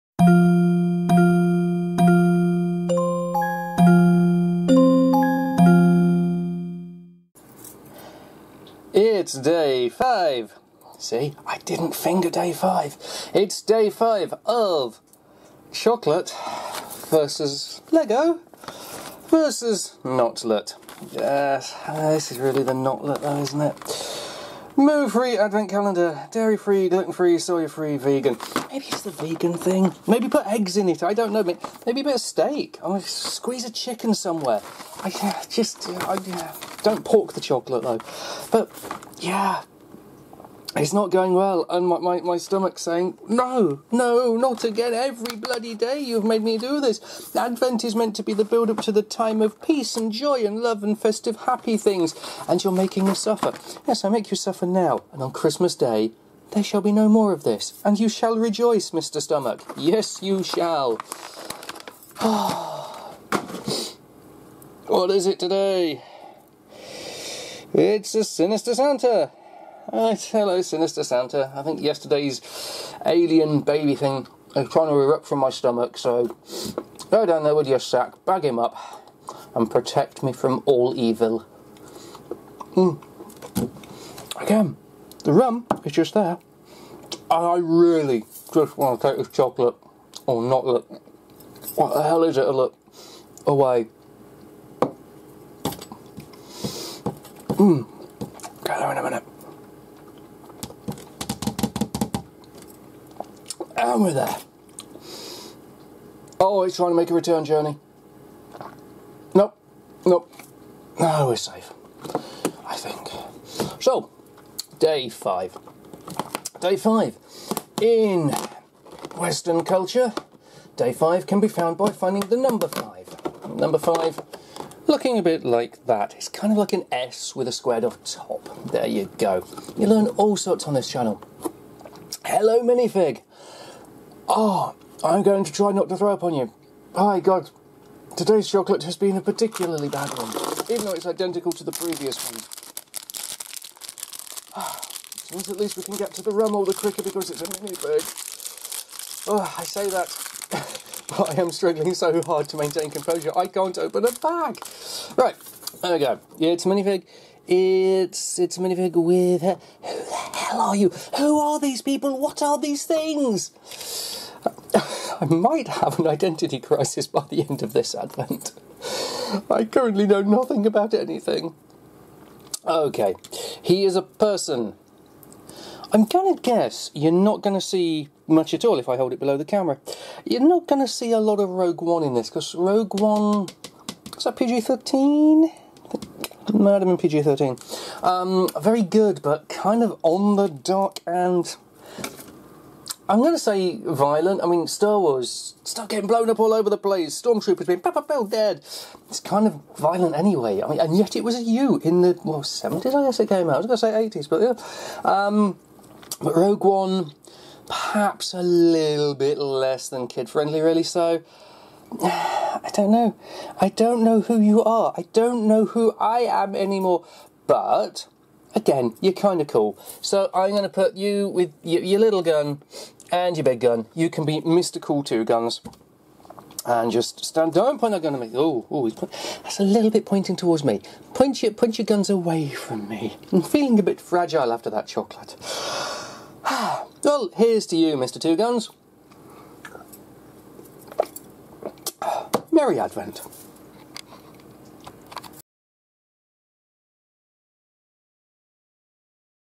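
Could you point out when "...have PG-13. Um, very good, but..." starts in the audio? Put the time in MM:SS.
03:06.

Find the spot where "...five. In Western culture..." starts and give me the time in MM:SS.
01:56.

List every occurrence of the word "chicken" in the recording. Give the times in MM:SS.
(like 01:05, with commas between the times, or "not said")
00:33.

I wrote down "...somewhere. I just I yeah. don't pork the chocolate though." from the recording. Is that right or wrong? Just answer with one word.
right.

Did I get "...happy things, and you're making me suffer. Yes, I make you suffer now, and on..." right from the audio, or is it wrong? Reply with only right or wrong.
right.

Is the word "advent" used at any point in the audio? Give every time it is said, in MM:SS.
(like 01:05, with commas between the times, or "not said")
00:25, 00:47, 02:47, 04:02.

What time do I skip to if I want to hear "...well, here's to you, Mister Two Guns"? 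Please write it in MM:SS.
03:57.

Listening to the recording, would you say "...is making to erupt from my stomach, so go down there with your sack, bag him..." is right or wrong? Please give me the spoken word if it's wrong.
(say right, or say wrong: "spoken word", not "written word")
wrong: "trying", not "making".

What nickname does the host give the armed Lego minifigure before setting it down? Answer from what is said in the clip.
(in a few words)
Mr. Cool Two Guns.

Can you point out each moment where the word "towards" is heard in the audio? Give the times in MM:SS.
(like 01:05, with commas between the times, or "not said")
03:50.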